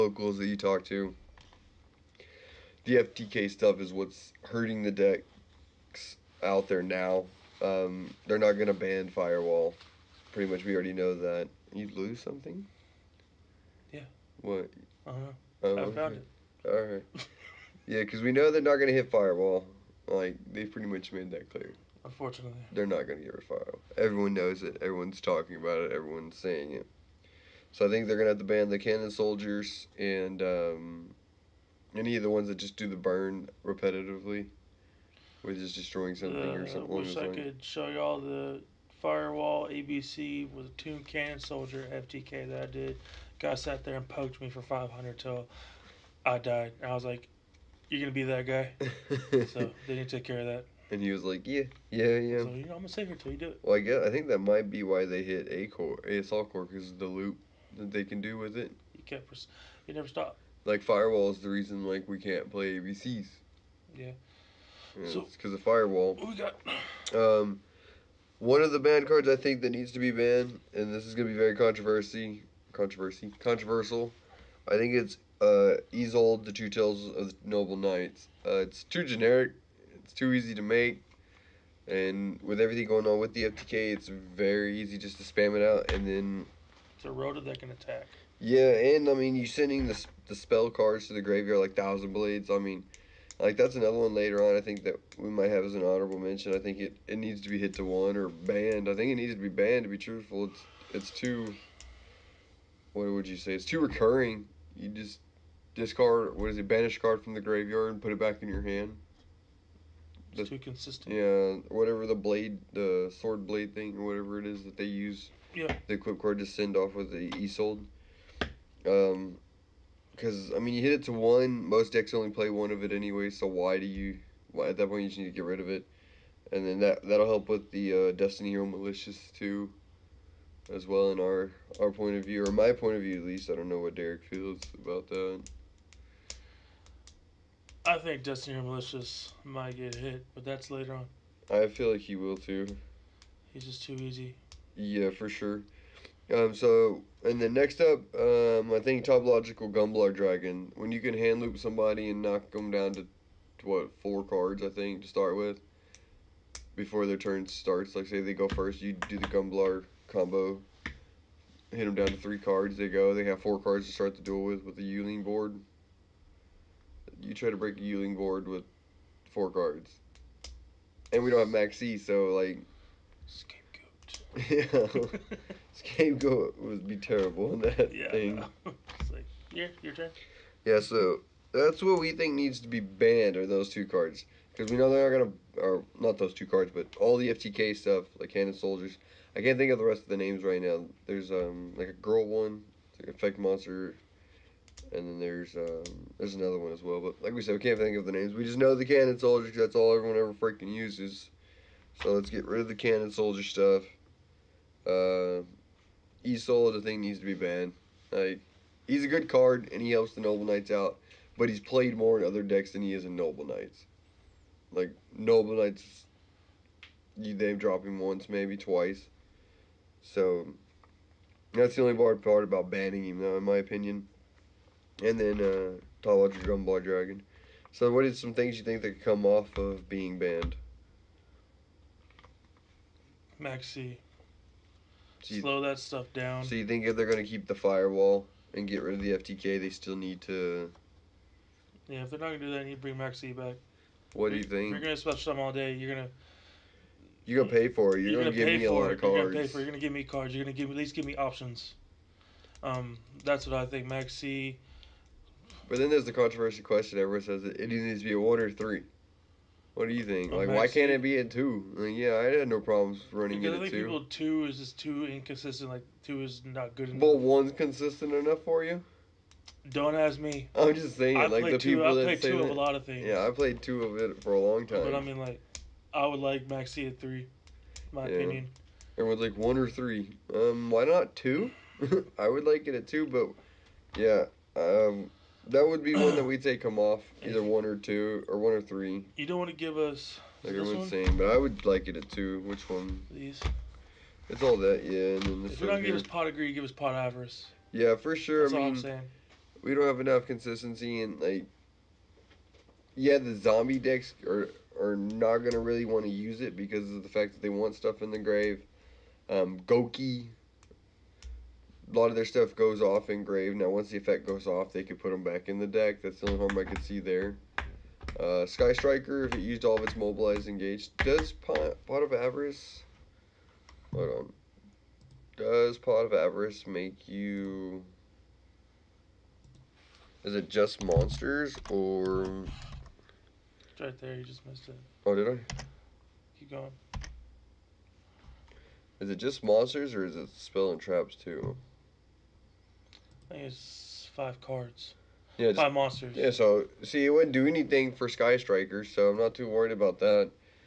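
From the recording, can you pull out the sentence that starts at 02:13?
I don't know what Derik feels about that.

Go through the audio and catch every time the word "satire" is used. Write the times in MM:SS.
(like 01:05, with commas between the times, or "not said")
not said.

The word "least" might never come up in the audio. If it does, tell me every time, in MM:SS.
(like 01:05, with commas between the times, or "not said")
02:13, 04:10.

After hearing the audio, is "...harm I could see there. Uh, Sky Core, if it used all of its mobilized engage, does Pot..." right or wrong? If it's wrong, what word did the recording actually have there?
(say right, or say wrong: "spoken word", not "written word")
wrong: "Striker", not "Core".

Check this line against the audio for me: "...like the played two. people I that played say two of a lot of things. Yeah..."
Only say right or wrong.
right.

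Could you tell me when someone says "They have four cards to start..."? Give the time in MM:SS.
02:43.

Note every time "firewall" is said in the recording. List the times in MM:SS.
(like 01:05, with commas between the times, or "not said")
00:09, 00:19, 00:23, 00:39, 01:00, 01:05, 03:57.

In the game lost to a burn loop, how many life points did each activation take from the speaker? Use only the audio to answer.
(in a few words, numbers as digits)
500.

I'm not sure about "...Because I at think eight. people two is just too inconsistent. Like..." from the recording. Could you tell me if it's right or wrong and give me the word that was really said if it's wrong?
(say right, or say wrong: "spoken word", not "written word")
wrong: "two", not "eight".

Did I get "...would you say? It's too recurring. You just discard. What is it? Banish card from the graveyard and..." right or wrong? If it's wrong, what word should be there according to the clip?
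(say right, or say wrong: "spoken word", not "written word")
right.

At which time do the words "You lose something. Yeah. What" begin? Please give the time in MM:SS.
00:11.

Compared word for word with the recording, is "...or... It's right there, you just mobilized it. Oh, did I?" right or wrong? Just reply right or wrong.
wrong.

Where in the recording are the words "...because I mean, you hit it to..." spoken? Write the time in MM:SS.
02:00.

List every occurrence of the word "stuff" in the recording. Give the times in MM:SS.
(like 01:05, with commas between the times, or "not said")
00:03, 03:07, 03:23, 03:55, 05:07, 05:12.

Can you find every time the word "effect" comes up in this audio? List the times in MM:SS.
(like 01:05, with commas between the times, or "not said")
03:13, 05:13.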